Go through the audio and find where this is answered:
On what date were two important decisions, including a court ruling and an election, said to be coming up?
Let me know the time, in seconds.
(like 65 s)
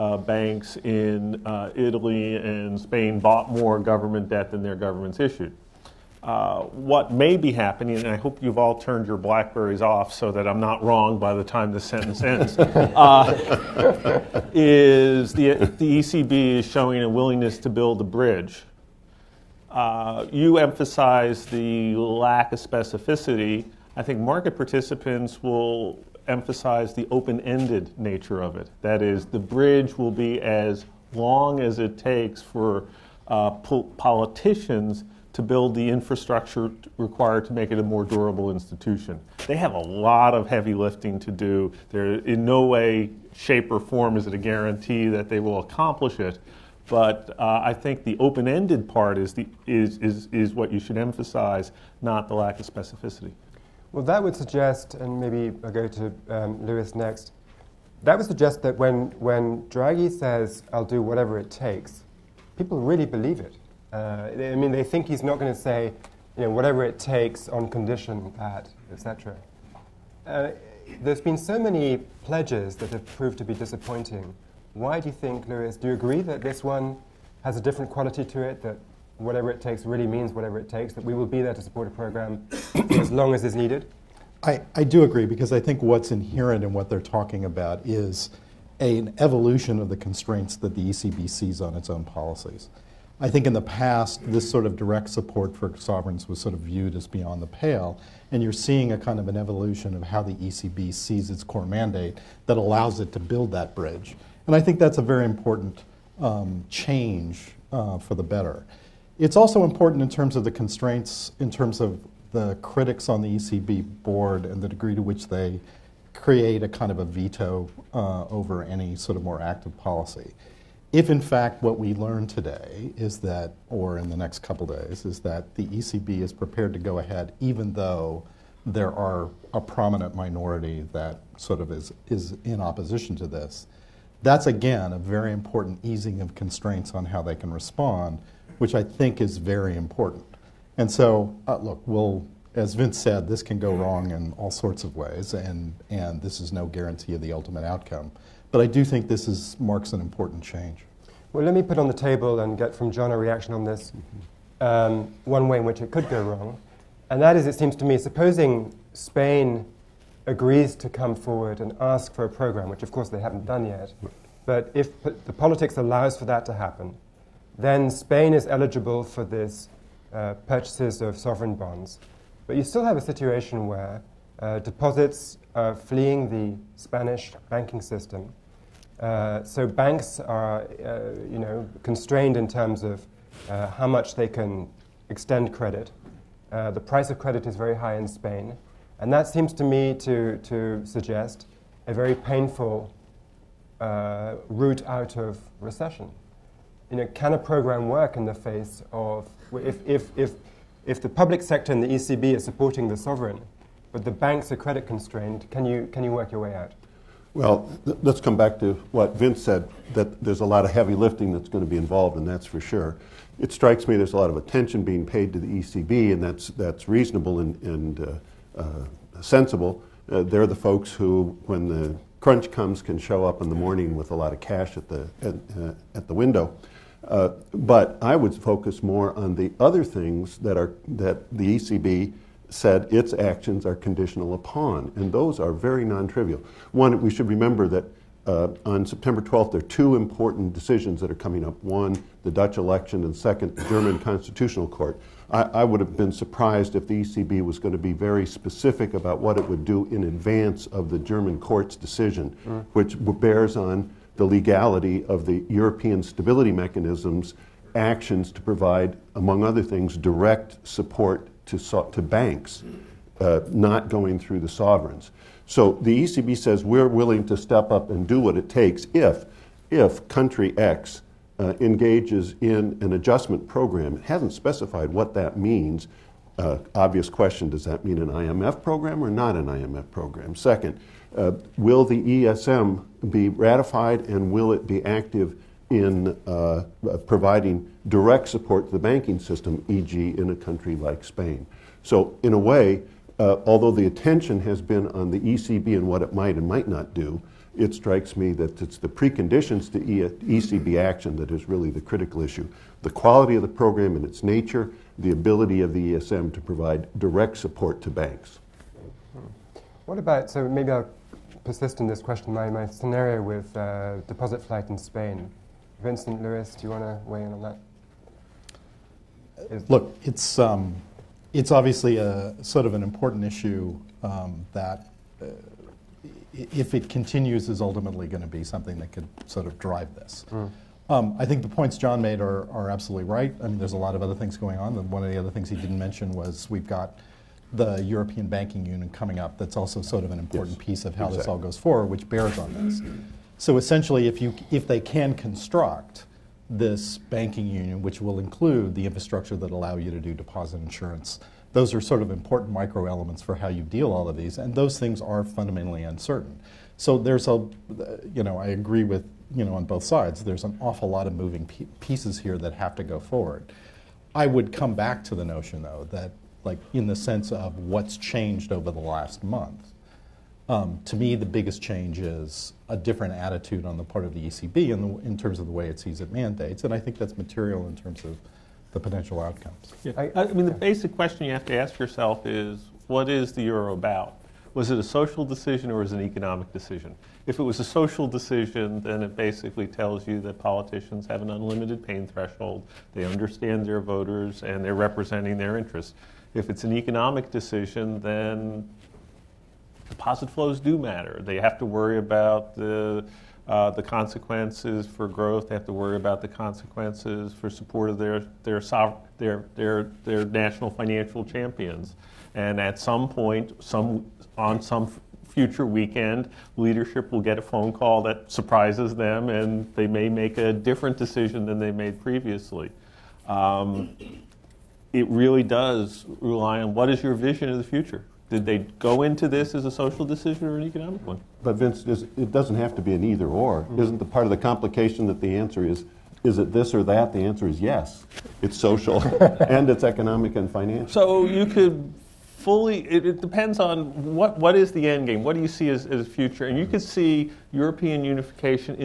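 238 s.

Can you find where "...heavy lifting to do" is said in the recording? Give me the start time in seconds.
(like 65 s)
40 s.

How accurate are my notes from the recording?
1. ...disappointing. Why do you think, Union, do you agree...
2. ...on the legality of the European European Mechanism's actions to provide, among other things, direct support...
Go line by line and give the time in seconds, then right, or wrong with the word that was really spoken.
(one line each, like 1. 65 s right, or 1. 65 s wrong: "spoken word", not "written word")
1. 73 s wrong: "Lewis", not "Union"
2. 253 s wrong: "Stability", not "European".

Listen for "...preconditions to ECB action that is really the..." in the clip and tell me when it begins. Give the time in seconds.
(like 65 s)
298 s.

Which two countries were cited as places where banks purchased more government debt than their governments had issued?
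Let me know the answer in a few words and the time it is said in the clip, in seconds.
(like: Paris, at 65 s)
Italy and Spain, at 1 s.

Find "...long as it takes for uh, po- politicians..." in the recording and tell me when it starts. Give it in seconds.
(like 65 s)
31 s.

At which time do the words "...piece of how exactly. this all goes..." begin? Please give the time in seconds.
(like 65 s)
340 s.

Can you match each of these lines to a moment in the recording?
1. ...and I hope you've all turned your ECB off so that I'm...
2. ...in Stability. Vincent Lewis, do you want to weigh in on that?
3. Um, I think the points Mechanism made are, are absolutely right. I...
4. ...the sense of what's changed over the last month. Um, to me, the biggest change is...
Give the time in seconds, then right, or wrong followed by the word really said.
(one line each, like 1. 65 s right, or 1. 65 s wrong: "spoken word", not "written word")
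1. 7 s wrong: "Blackberries", not "ECB"
2. 314 s wrong: "Spain", not "Stability"
3. 330 s wrong: "John", not "Mechanism"
4. 366 s right.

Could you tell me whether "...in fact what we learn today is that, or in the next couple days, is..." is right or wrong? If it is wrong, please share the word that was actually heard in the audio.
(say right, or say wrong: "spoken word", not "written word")
right.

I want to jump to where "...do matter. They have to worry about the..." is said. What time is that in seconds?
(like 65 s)
400 s.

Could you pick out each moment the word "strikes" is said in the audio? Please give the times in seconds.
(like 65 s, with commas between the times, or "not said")
213 s, 297 s.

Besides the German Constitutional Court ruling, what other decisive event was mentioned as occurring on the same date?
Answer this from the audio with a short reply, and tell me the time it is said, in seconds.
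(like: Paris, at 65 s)
Dutch election, at 242 s.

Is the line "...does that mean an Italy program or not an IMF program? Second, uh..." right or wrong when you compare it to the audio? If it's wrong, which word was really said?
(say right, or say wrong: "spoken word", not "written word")
wrong: "IMF", not "Italy".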